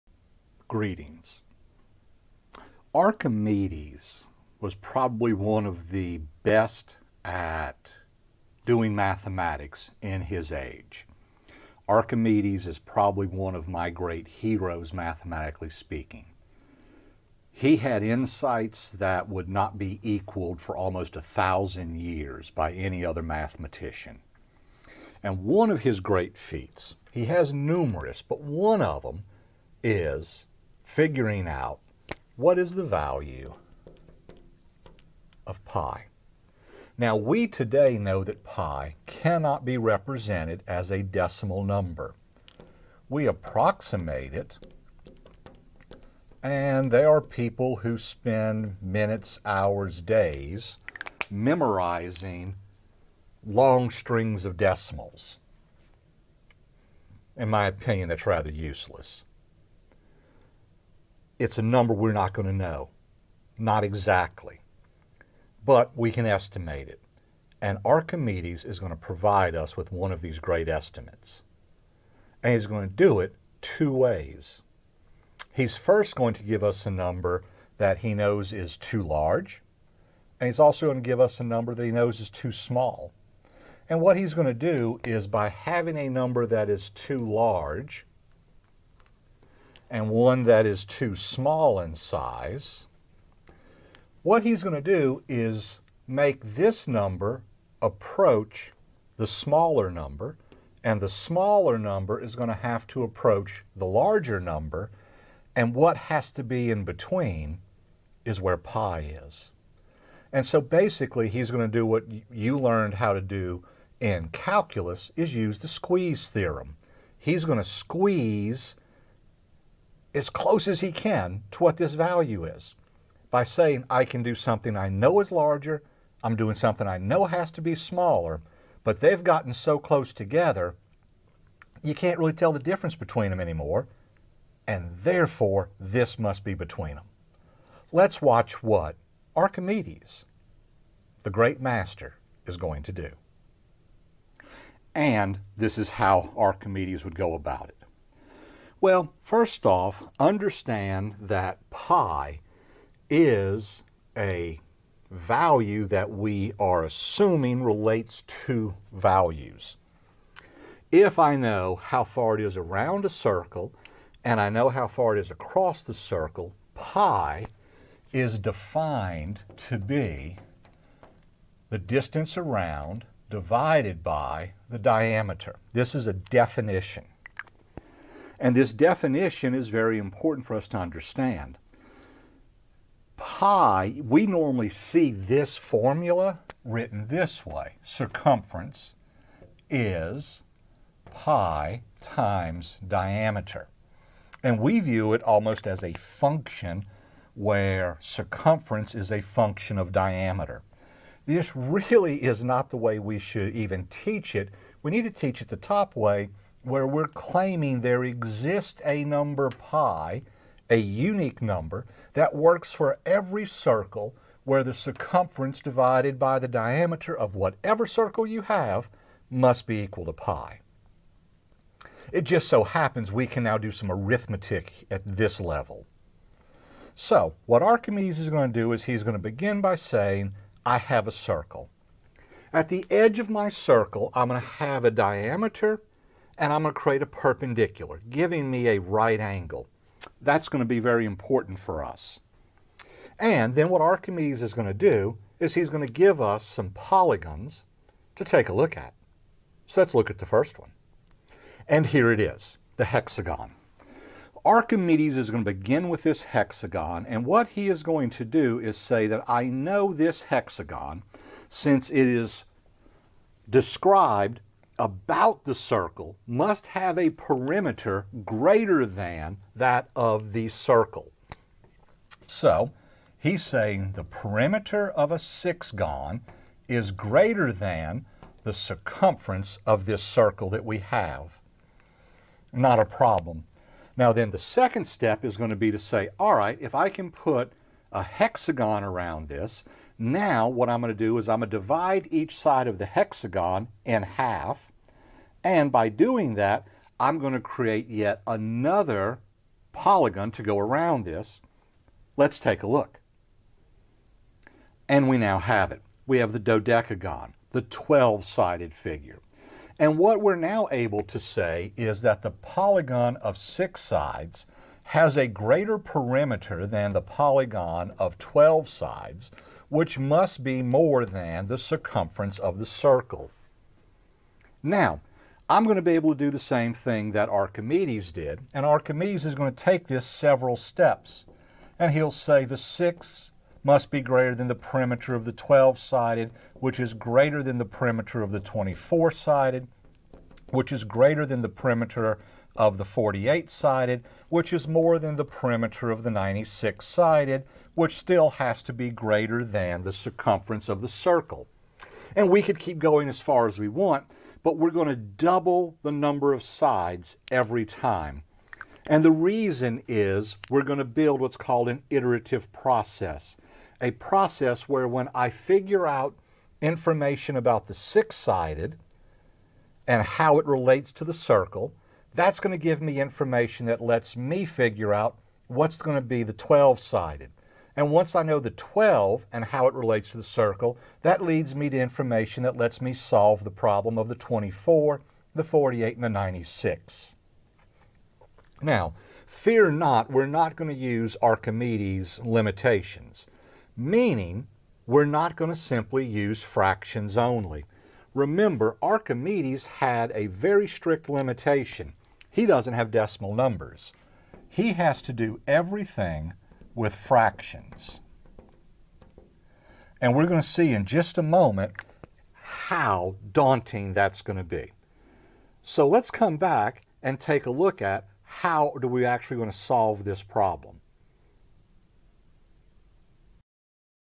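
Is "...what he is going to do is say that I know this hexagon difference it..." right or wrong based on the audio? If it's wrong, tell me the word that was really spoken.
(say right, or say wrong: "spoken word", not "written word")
wrong: "since", not "difference".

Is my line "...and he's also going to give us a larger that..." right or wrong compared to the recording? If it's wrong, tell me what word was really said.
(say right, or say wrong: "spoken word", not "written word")
wrong: "number", not "larger".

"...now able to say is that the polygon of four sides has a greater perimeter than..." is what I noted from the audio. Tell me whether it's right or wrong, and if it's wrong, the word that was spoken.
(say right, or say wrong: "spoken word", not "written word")
wrong: "six", not "four".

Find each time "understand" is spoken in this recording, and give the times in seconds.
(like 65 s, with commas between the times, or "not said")
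150 s, 180 s.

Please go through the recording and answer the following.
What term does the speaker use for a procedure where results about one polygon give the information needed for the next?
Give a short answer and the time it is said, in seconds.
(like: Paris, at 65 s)
iterative process, at 361 s.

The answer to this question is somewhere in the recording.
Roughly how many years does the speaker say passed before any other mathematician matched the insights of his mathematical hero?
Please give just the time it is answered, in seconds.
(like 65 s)
20 s.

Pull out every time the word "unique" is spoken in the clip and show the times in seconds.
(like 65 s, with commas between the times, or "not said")
210 s.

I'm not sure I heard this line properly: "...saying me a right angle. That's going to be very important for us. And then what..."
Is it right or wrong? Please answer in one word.
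wrong.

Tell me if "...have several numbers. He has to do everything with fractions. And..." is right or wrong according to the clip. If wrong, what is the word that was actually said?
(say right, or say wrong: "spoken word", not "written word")
wrong: "decimal", not "several".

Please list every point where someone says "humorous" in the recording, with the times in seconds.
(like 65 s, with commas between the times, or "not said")
not said.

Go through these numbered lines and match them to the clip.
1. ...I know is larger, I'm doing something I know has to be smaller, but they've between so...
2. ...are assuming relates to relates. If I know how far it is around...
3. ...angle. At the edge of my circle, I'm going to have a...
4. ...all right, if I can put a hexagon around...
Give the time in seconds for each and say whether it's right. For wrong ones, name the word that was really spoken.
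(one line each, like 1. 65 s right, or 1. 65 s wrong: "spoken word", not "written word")
1. 124 s wrong: "gotten", not "between"
2. 156 s wrong: "values", not "relates"
3. 231 s wrong: "circle", not "angle"
4. 286 s right.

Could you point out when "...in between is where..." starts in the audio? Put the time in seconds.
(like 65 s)
106 s.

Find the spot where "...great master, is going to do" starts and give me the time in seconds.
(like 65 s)
141 s.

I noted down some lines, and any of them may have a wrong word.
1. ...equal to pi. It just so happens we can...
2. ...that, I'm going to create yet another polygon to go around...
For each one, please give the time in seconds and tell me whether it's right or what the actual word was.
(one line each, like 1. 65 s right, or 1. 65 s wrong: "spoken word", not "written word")
1. 219 s right
2. 296 s right.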